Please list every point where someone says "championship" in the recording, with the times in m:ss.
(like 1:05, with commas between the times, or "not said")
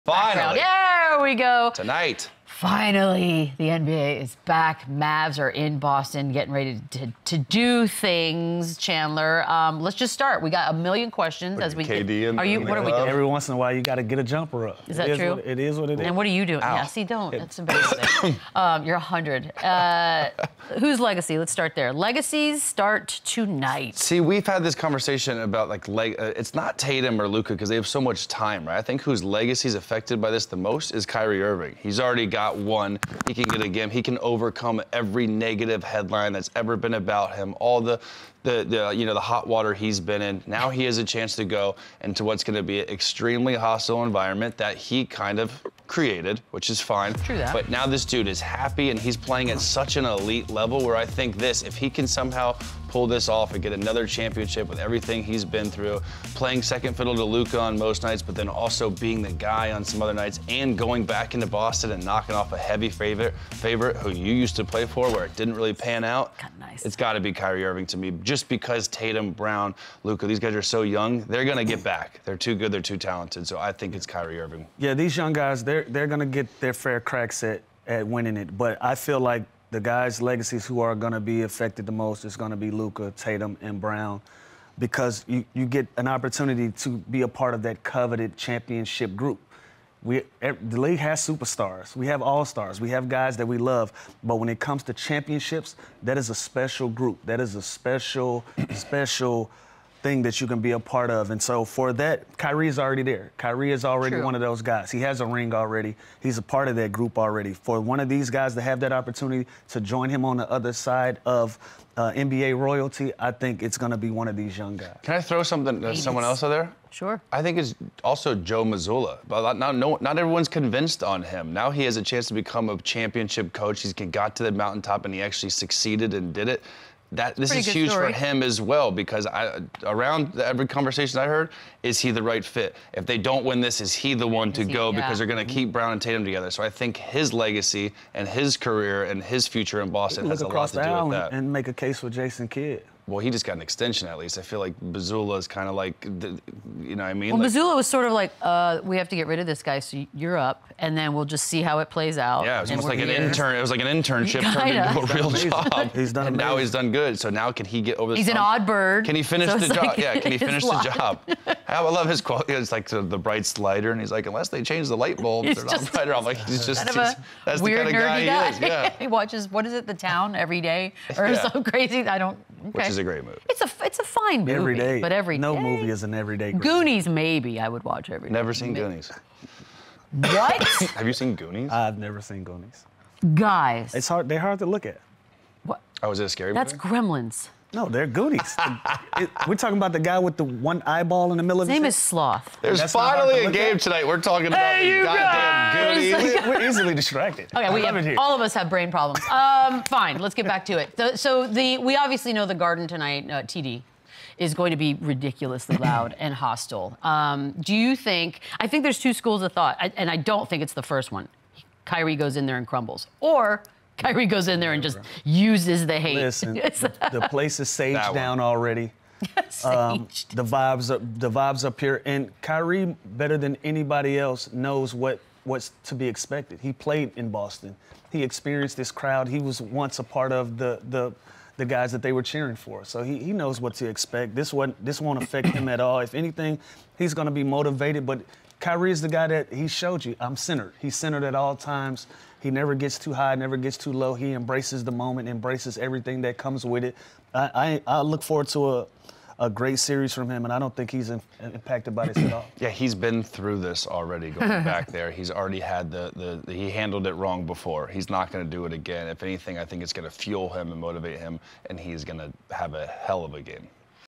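0:54, 1:28, 1:34, 2:02.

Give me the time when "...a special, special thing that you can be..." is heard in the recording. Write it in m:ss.
1:37.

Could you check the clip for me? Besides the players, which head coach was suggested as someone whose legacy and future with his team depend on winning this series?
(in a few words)
Joe Mazzulla.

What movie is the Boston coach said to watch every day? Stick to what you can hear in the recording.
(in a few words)
The Town.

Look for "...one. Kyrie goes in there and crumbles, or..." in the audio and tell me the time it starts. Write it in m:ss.
3:31.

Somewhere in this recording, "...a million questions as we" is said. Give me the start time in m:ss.
0:10.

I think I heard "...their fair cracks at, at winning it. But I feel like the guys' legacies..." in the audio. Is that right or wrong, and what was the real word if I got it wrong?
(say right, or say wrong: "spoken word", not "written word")
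right.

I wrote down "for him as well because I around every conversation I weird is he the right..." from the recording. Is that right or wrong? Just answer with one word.
wrong.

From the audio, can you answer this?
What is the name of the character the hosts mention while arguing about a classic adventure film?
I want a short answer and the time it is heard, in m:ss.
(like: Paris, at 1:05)
Sloth, at 3:11.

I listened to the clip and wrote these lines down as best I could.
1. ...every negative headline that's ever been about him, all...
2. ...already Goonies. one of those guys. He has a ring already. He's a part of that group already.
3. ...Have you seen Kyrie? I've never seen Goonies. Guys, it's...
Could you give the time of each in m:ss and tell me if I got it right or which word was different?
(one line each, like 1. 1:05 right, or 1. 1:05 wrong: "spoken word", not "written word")
1. 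0:34 right
2. 1:43 wrong: "True", not "Goonies"
3. 3:00 wrong: "Goonies", not "Kyrie".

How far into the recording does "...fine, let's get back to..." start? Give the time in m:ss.
3:19.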